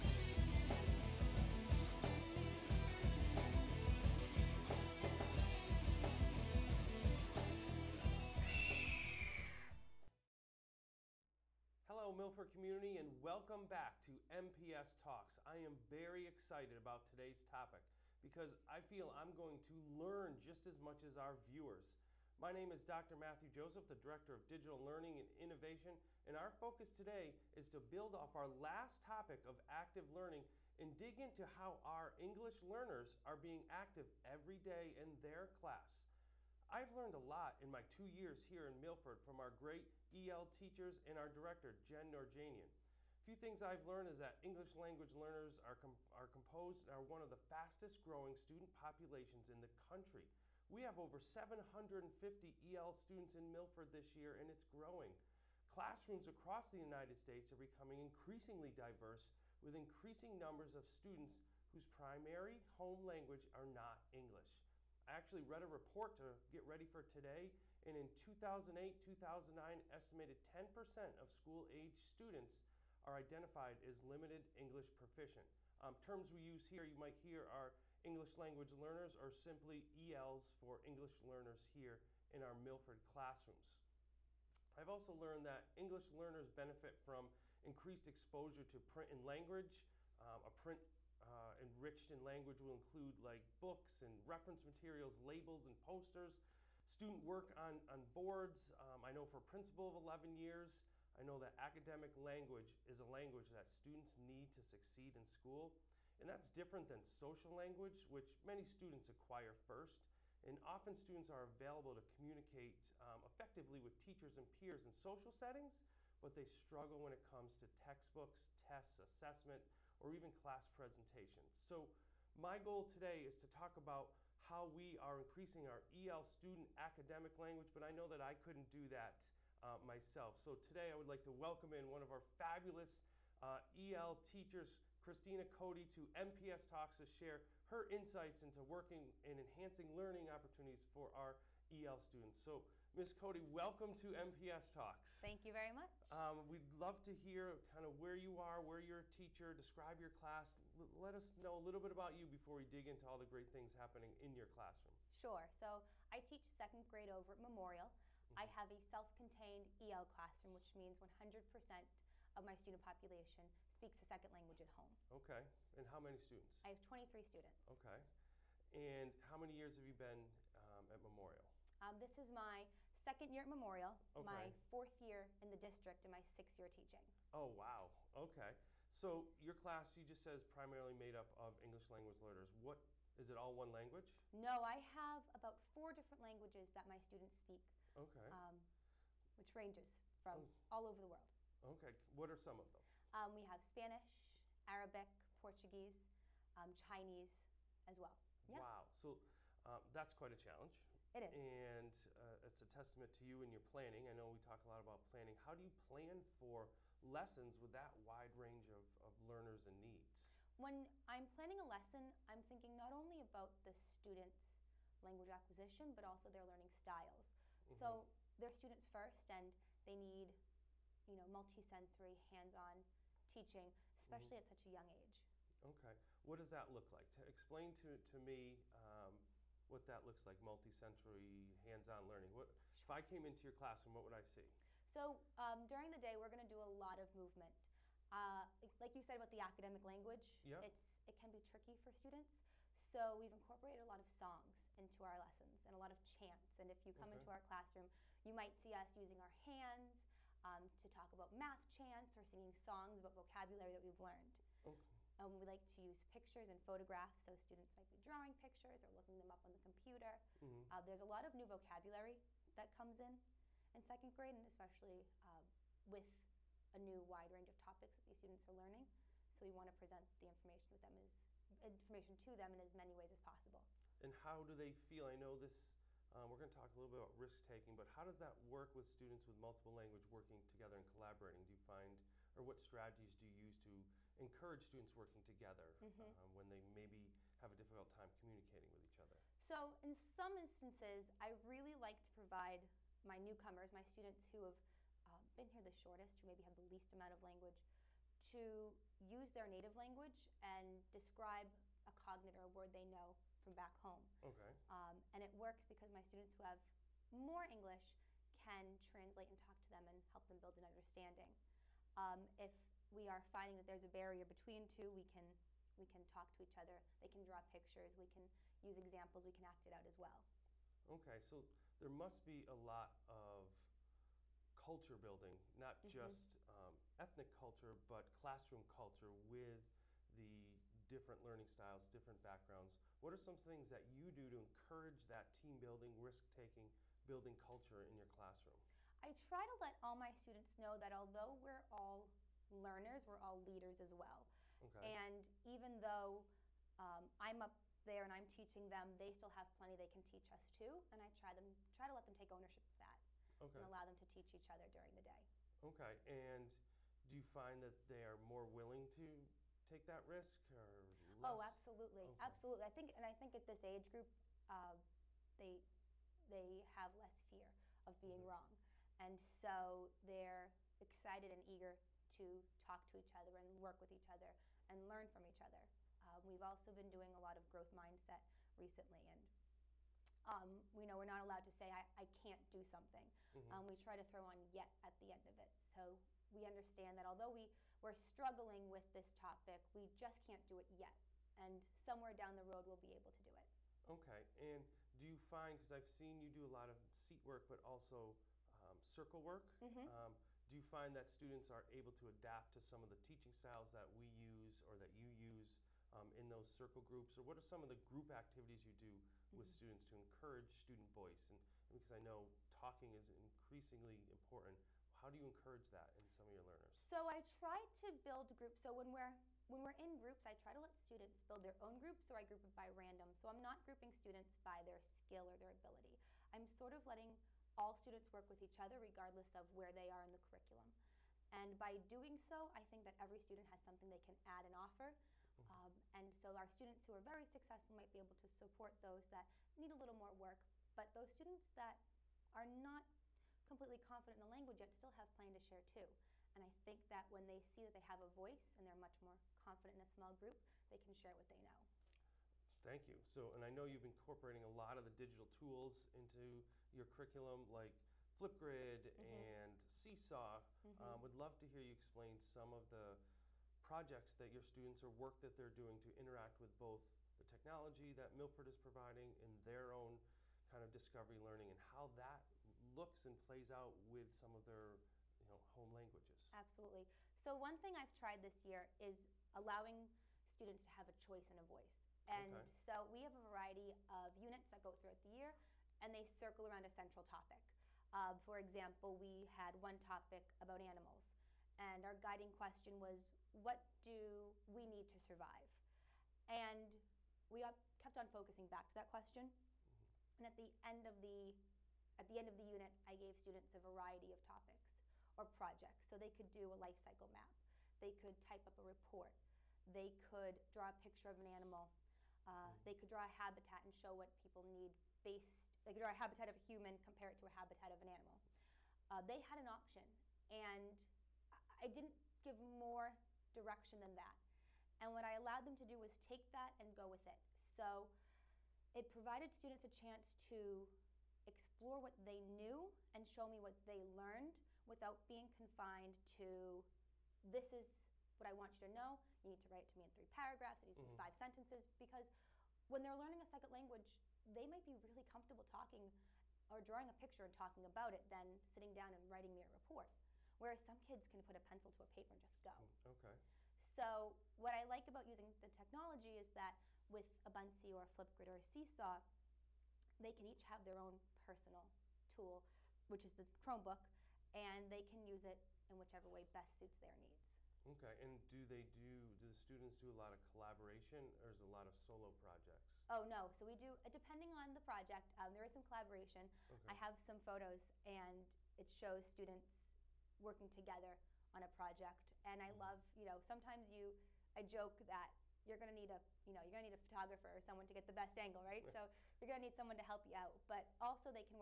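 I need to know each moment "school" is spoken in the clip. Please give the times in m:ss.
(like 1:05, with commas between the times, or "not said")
1:11, 1:45.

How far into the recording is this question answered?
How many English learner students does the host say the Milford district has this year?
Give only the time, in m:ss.
0:50.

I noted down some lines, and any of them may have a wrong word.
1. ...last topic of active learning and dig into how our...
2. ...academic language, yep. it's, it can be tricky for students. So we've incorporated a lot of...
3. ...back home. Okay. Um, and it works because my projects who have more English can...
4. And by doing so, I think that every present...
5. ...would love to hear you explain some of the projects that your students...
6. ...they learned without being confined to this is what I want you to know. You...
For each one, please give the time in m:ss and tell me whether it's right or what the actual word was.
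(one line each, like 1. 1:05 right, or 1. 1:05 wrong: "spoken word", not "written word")
1. 0:28 right
2. 3:59 right
3. 5:03 wrong: "students", not "projects"
4. 7:11 wrong: "student", not "present"
5. 7:41 right
6. 8:53 right.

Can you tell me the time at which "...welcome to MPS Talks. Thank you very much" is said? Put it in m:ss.
2:23.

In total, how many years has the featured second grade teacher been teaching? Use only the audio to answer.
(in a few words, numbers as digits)
6.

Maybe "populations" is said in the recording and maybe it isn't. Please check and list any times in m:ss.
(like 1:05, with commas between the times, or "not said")
0:48, 2:42.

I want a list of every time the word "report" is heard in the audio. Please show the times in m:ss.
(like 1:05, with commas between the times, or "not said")
1:05, 8:28, 9:09.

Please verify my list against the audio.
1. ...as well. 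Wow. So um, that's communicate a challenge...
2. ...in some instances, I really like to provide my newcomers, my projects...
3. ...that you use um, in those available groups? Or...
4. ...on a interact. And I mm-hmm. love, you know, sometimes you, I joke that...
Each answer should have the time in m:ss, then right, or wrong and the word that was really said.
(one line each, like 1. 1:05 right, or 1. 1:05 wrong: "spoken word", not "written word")
1. 3:17 wrong: "quite", not "communicate"
2. 4:49 wrong: "students", not "projects"
3. 6:44 wrong: "circle", not "available"
4. 9:41 wrong: "project", not "interact".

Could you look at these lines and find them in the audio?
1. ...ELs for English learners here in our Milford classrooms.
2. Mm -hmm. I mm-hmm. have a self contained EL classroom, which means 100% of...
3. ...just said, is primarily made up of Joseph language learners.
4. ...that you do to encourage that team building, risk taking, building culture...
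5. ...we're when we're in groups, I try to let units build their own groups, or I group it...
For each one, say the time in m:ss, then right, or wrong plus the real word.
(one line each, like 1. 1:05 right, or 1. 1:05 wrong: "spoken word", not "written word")
1. 1:20 right
2. 2:37 right
3. 3:00 wrong: "English", not "Joseph"
4. 5:33 right
5. 6:58 wrong: "students", not "units".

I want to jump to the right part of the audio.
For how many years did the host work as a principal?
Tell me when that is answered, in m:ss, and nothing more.
1:39.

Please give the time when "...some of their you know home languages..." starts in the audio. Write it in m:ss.
7:54.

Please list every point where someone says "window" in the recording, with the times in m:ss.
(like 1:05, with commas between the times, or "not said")
not said.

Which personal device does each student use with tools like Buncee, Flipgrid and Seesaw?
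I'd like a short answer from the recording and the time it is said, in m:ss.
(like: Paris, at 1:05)
Chromebook, at 9:23.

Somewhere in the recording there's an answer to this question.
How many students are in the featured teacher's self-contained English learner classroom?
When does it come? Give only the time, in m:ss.
2:46.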